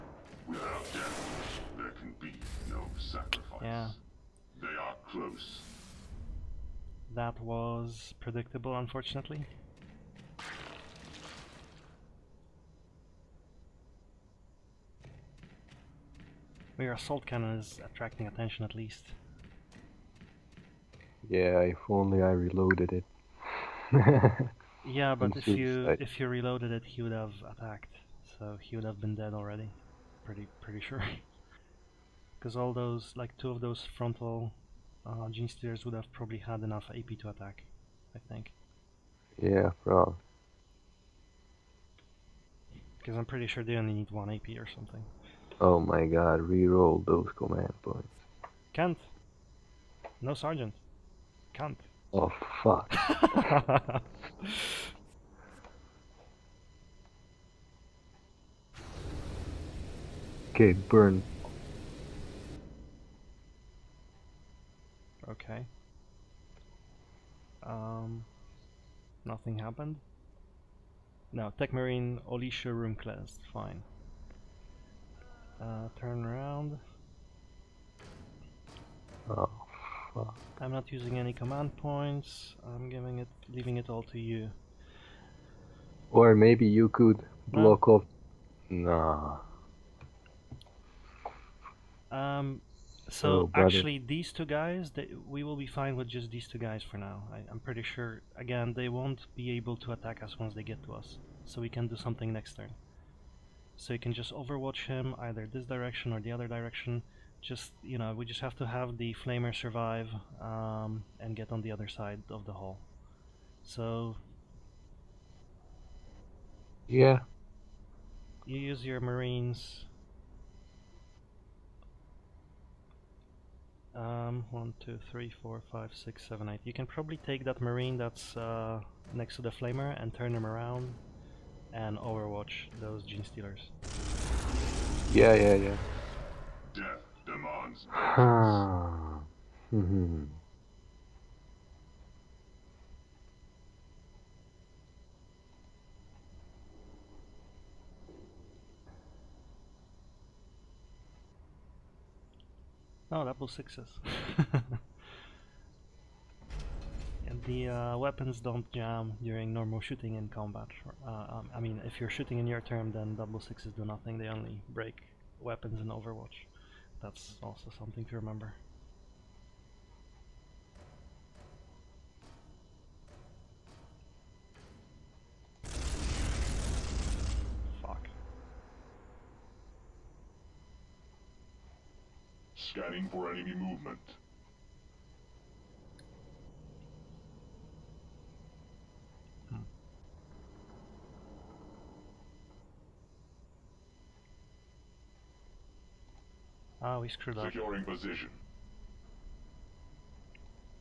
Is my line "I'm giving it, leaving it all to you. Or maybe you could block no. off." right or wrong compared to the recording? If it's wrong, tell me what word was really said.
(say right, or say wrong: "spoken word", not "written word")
right.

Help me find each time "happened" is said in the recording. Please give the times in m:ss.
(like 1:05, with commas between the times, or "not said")
1:09.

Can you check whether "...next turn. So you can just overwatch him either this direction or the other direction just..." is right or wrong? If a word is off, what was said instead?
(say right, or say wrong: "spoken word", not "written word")
right.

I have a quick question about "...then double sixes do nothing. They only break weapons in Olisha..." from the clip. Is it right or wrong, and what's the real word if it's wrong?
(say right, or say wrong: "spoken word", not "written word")
wrong: "Overwatch", not "Olisha".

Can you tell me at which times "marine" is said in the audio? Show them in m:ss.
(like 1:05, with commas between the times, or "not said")
1:11, 1:58, 2:07.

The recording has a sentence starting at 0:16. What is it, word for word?
Your assault cannon is attracting attention at least.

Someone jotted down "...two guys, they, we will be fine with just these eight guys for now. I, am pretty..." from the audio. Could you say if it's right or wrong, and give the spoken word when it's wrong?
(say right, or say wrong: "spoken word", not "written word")
wrong: "two", not "eight".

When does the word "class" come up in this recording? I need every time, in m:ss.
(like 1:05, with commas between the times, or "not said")
1:12.